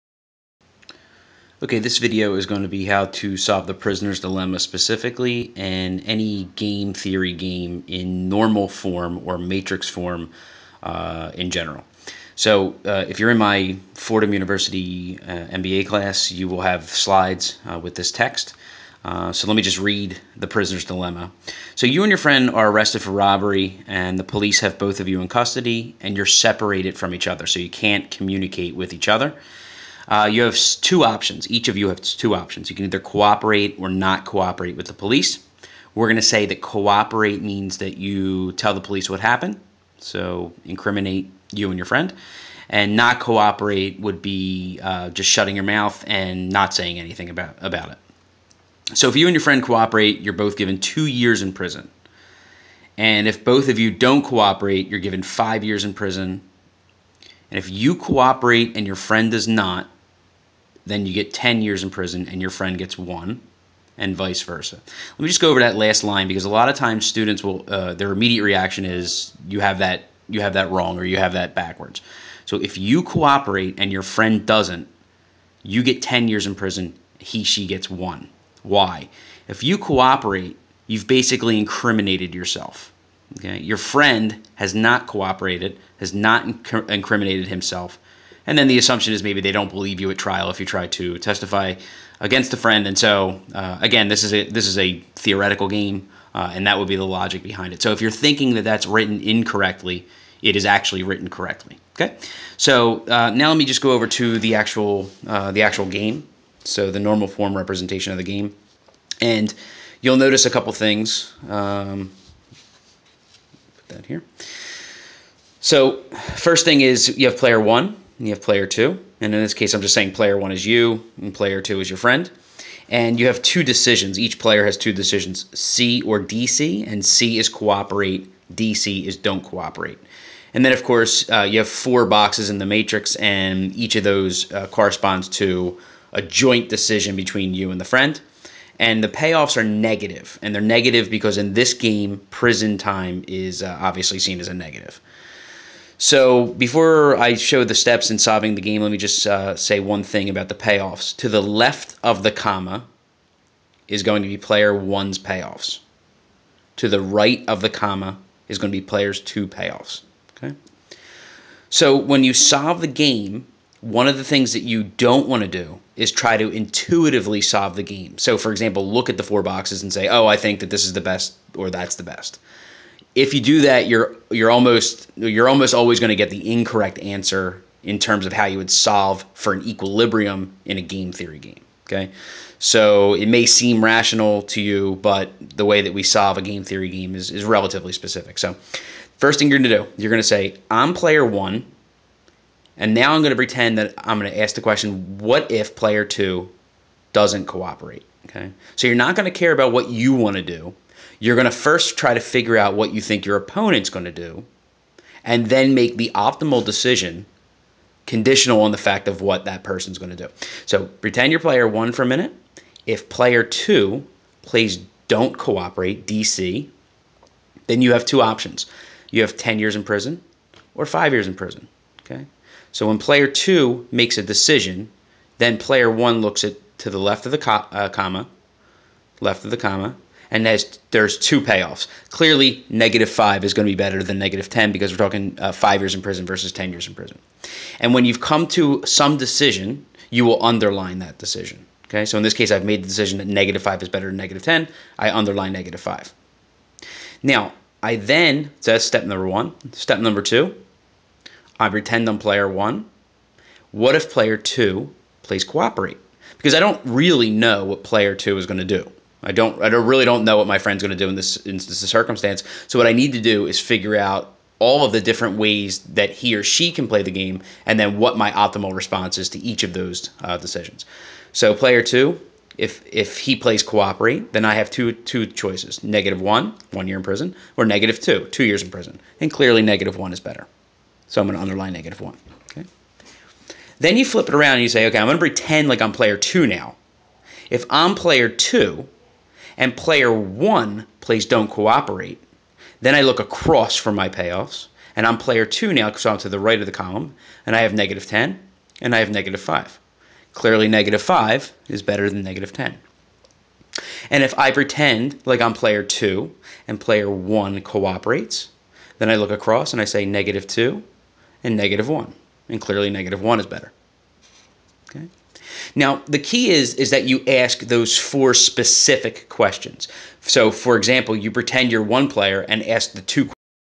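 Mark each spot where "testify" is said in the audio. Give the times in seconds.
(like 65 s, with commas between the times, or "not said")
91 s.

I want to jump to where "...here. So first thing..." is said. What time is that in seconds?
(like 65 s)
114 s.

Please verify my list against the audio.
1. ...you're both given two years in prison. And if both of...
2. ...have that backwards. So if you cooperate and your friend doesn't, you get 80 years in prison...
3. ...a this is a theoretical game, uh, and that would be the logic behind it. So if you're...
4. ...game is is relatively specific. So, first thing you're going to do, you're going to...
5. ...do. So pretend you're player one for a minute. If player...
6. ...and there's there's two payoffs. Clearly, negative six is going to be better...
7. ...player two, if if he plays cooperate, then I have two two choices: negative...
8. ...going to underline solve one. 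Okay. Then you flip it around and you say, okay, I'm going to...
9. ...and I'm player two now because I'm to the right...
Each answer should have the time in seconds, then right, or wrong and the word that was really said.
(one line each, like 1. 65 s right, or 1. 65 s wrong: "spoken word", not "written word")
1. 50 s right
2. 71 s wrong: "10", not "80"
3. 94 s right
4. 186 s right
5. 210 s right
6. 230 s wrong: "five", not "six"
7. 271 s right
8. 281 s wrong: "negative", not "solve"
9. 294 s right.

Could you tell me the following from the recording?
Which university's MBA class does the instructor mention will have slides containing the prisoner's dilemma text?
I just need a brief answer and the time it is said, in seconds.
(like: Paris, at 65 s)
Fordham University, at 13 s.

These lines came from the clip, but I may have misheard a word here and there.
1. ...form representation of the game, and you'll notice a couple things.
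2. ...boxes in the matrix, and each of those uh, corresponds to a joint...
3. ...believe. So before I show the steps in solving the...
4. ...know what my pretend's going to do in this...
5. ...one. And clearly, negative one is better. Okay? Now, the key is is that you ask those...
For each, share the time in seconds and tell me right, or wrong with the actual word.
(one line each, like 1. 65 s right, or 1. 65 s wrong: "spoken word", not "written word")
1. 107 s right
2. 132 s right
3. 144 s wrong: "negative", not "believe"
4. 260 s wrong: "friend", not "pretend"
5. 311 s right.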